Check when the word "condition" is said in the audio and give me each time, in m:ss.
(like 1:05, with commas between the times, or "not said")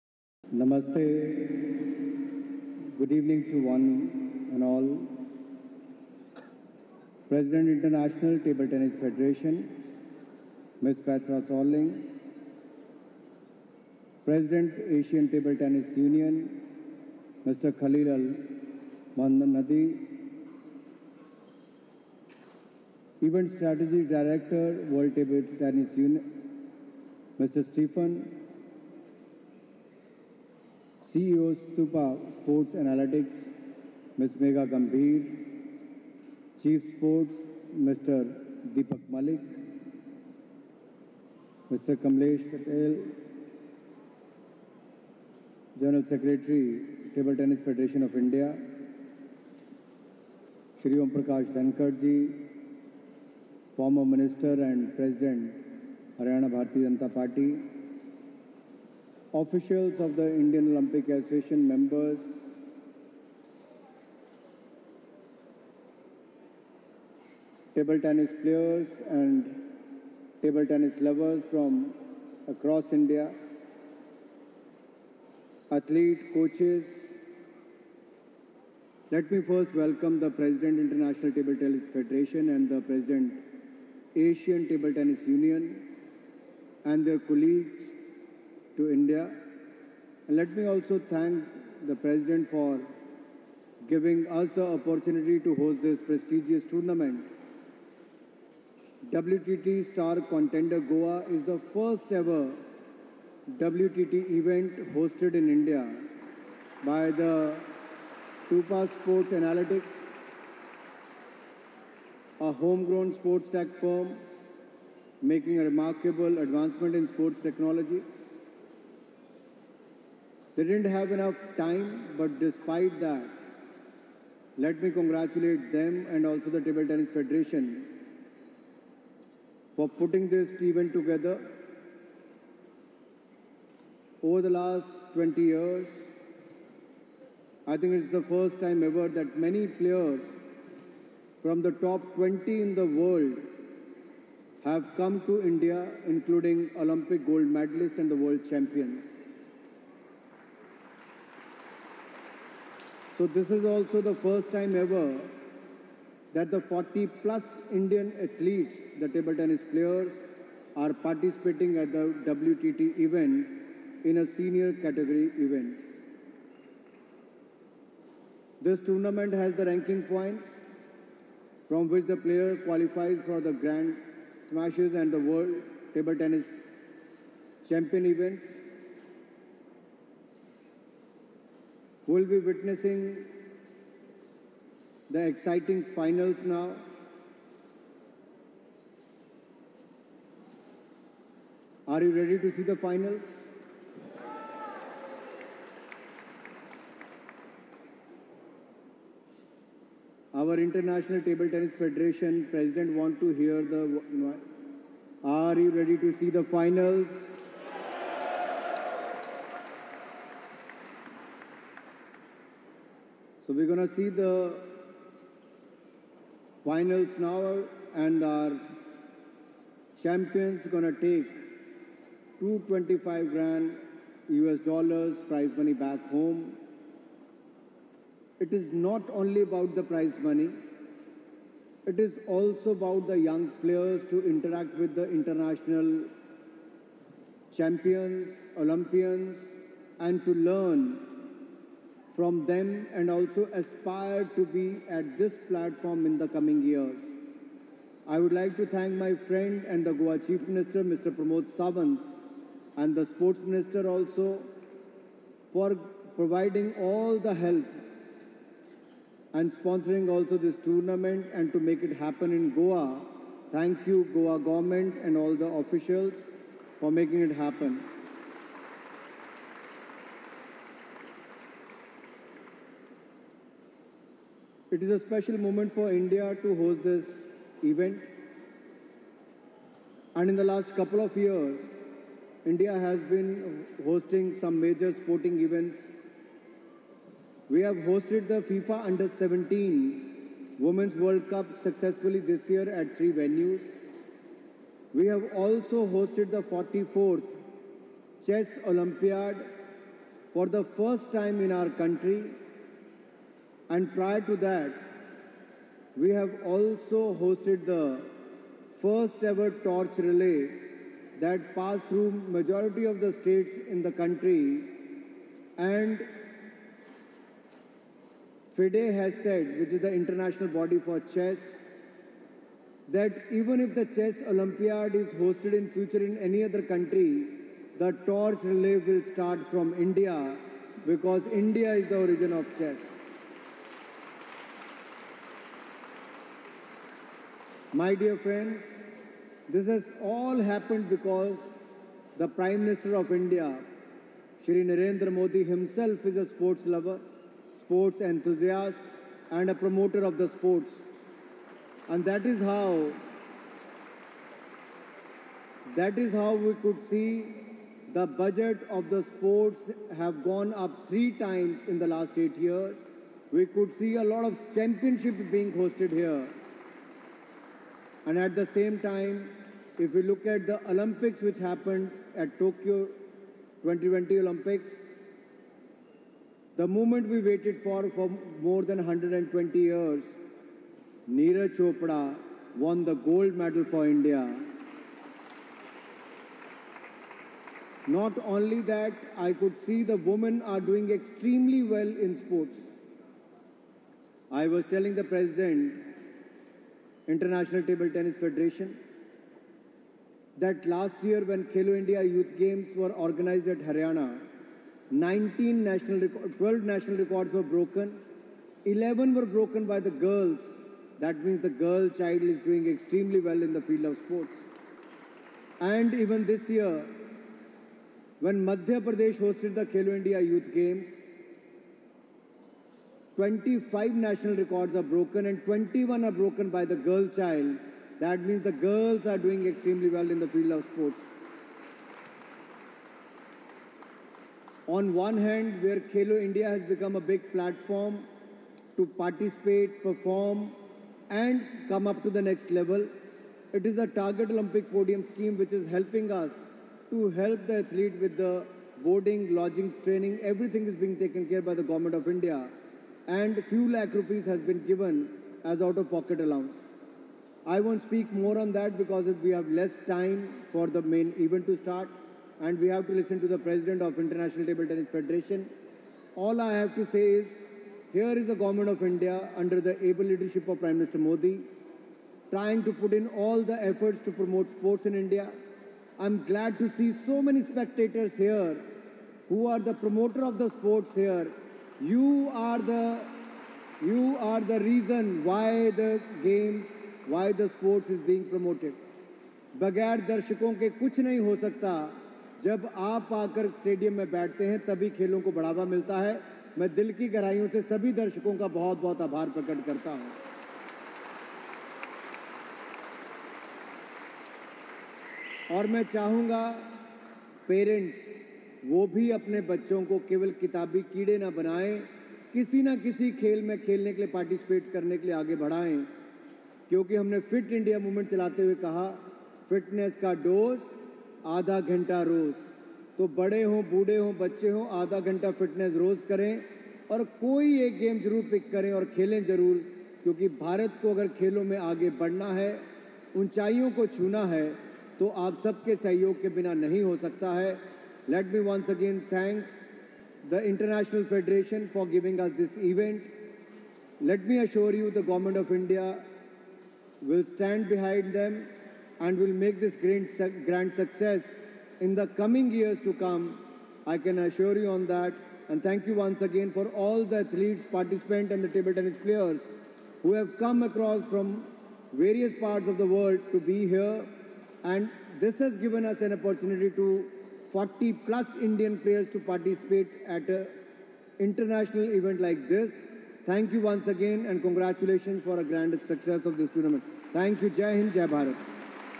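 not said.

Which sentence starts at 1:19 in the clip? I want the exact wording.
Let me first welcome the President International Table Tennis Federation and the President Asian Table Tennis Union and their colleagues to India.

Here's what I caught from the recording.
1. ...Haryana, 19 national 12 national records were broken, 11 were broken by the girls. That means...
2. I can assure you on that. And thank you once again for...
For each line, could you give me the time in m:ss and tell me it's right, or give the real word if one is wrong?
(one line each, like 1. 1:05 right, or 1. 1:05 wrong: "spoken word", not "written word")
1. 6:43 right
2. 9:13 right.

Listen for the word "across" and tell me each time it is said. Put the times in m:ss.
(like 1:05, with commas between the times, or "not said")
1:12, 9:20.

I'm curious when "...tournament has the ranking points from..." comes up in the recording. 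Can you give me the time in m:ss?
2:48.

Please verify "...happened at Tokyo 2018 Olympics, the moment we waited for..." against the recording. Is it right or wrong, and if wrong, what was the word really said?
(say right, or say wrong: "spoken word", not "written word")
wrong: "2020", not "2018".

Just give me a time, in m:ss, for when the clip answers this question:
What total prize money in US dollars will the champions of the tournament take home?
3:42.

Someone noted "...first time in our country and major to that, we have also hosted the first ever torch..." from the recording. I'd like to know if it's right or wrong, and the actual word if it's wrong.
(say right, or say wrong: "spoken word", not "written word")
wrong: "prior", not "major".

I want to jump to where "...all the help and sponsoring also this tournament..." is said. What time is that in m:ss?
4:16.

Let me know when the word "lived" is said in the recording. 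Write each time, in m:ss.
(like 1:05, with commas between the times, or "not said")
not said.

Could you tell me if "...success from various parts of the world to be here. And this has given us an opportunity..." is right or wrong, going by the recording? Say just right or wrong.
wrong.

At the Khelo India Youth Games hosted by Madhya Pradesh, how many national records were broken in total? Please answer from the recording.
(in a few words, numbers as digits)
25.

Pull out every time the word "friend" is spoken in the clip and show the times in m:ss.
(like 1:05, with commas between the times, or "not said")
4:09, 5:38.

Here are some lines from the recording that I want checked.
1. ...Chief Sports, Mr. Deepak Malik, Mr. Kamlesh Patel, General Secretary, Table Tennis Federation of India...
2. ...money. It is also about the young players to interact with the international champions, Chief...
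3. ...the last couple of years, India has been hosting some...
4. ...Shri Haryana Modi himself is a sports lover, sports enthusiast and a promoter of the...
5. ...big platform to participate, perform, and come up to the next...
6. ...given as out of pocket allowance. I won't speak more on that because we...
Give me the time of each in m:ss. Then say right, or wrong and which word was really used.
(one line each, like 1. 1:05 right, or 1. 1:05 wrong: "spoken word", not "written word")
1. 0:36 right
2. 3:50 wrong: "Olympians", not "Chief"
3. 4:40 right
4. 5:44 wrong: "Narendra", not "Haryana"
5. 7:17 right
6. 7:34 right.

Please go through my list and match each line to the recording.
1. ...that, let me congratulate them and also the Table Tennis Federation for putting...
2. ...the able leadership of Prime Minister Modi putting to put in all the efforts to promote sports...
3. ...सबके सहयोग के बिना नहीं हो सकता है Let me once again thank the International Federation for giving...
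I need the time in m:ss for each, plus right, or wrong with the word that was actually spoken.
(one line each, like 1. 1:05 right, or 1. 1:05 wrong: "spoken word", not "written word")
1. 2:02 right
2. 7:49 wrong: "trying", not "putting"
3. 8:55 right.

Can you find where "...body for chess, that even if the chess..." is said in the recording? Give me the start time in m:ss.
5:20.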